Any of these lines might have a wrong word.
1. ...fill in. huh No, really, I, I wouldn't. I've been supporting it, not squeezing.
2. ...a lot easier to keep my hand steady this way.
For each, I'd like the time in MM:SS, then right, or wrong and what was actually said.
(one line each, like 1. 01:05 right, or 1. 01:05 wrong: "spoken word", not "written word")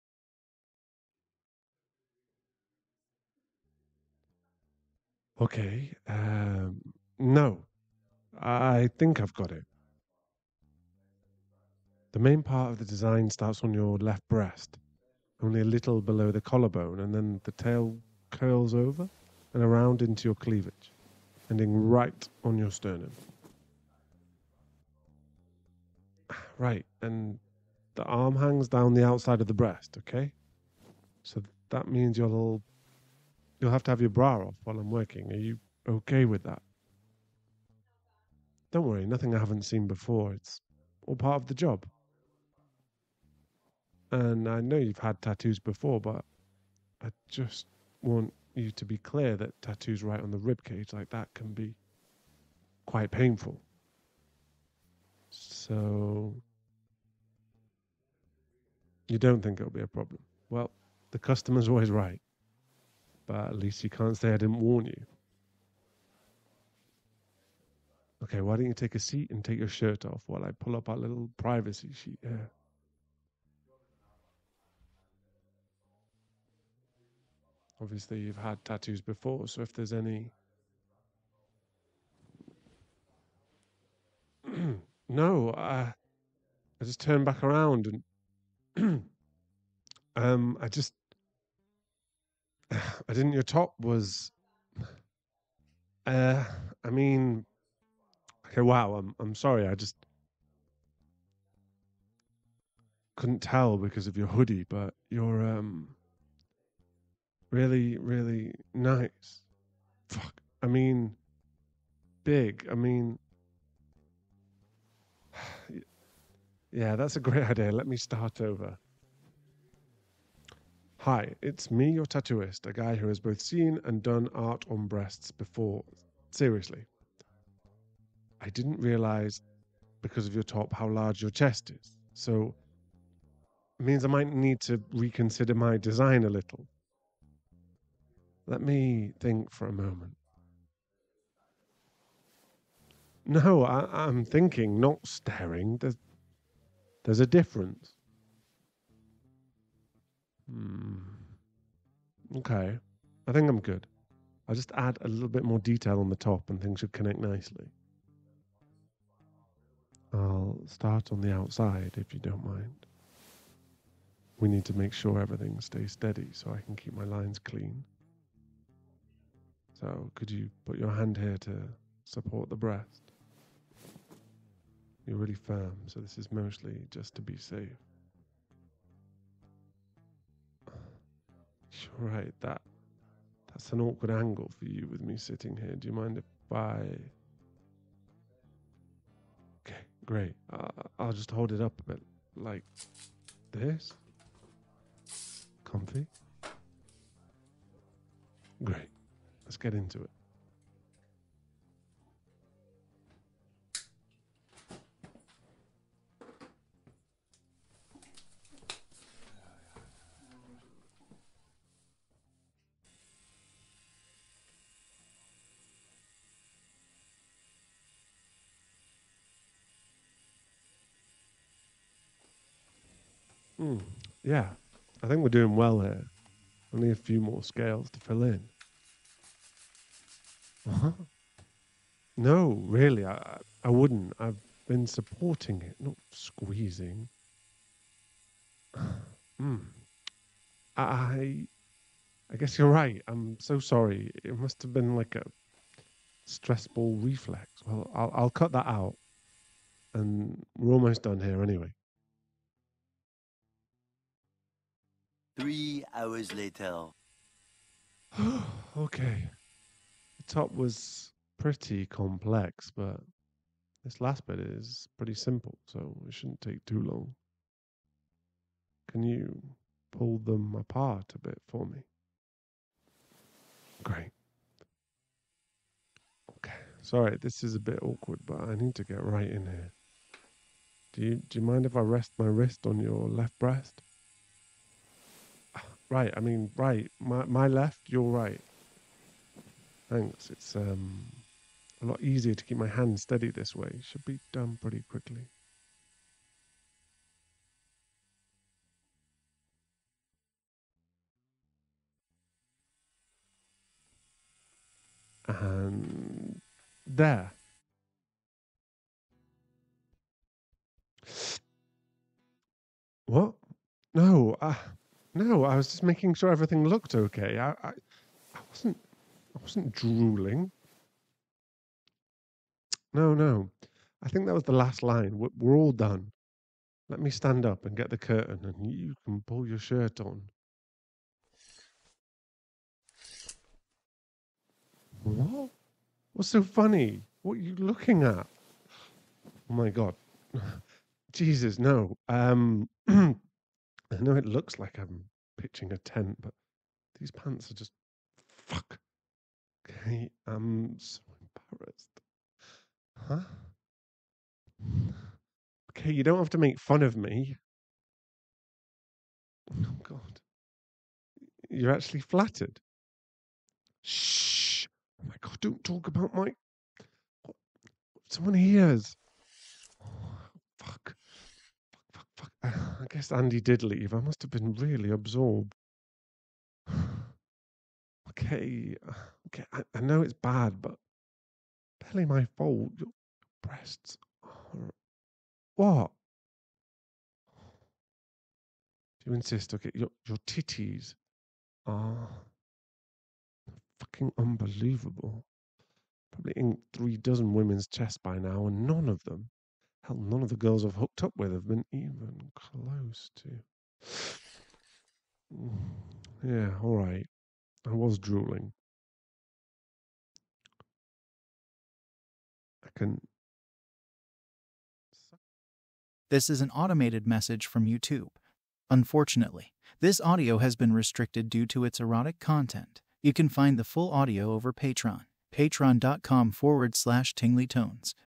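1. 03:47 right
2. 04:51 right.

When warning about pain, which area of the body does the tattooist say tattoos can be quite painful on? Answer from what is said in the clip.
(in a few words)
rib cage.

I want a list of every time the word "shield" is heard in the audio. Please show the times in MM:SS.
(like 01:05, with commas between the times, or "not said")
not said.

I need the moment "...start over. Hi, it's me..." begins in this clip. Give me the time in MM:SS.
01:57.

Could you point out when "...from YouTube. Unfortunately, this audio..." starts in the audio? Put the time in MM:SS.
06:57.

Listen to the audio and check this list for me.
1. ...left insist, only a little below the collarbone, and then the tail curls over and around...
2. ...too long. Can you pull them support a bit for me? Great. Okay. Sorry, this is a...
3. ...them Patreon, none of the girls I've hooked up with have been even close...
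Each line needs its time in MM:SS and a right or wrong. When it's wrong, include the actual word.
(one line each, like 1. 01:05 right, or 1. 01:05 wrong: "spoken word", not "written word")
1. 00:13 wrong: "breast", not "insist"
2. 04:26 wrong: "apart", not "support"
3. 06:39 wrong: "Hell", not "Patreon".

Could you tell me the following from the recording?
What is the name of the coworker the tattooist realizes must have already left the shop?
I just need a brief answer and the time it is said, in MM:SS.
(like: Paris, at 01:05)
Andy, at 06:13.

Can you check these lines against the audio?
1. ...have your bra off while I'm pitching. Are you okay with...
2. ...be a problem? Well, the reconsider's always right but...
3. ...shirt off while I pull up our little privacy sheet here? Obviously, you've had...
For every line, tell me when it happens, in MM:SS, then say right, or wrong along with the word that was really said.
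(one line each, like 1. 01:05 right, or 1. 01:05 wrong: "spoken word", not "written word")
1. 00:33 wrong: "working", not "pitching"
2. 00:59 wrong: "customer", not "reconsider"
3. 01:09 right.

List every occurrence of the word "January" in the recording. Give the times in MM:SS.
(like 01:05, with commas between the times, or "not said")
not said.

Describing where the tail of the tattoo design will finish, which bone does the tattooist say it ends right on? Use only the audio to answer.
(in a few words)
sternum.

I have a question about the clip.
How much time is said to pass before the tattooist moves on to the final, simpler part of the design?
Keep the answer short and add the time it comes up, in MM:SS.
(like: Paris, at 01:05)
3 hours, at 04:15.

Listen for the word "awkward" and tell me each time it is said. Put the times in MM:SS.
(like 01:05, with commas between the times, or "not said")
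03:03, 04:37.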